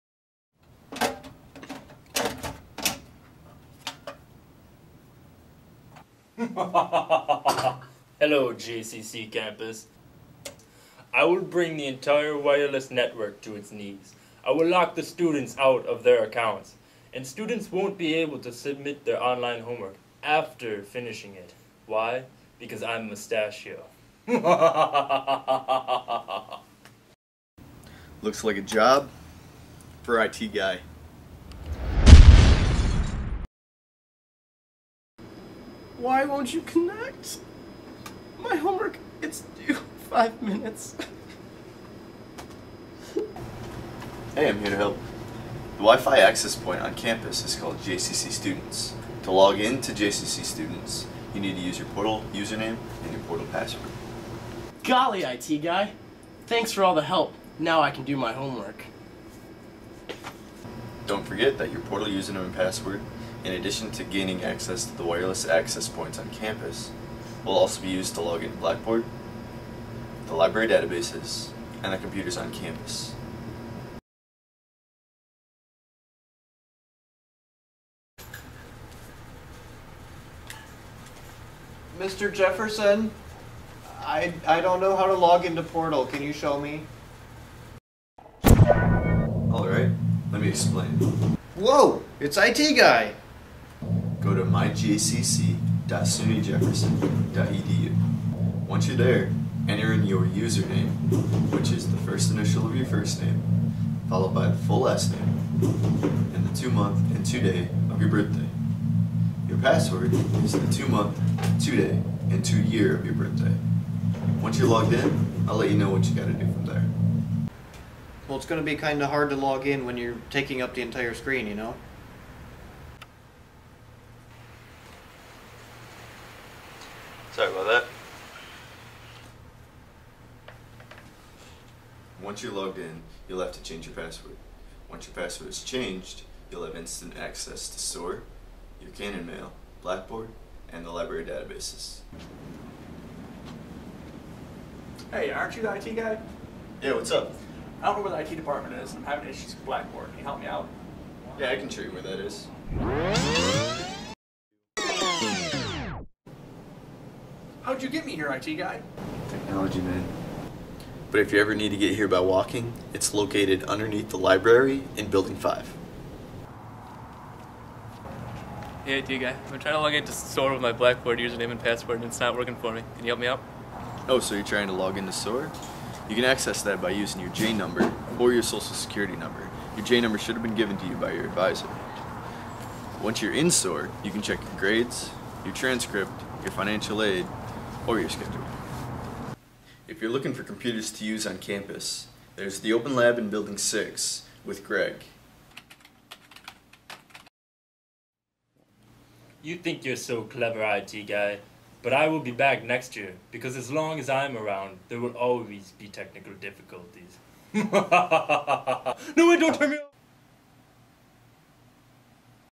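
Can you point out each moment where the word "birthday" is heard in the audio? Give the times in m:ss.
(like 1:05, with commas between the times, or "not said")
1:48, 1:53.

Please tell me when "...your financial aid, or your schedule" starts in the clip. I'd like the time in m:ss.
3:06.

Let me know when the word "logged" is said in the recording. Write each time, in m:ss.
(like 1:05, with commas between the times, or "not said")
1:54, 2:12.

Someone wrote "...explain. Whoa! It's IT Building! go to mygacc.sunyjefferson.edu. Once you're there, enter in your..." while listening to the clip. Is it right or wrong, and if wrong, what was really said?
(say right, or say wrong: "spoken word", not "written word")
wrong: "Guy", not "Building".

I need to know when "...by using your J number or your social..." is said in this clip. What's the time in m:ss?
2:56.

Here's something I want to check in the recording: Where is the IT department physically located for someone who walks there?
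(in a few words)
underneath the library in Building 5.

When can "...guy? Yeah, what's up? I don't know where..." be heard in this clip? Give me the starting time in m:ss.
2:25.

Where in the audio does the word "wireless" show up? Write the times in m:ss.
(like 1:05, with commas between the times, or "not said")
0:12, 1:05.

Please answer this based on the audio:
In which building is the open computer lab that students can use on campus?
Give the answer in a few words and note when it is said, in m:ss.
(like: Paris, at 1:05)
Building 6, at 3:13.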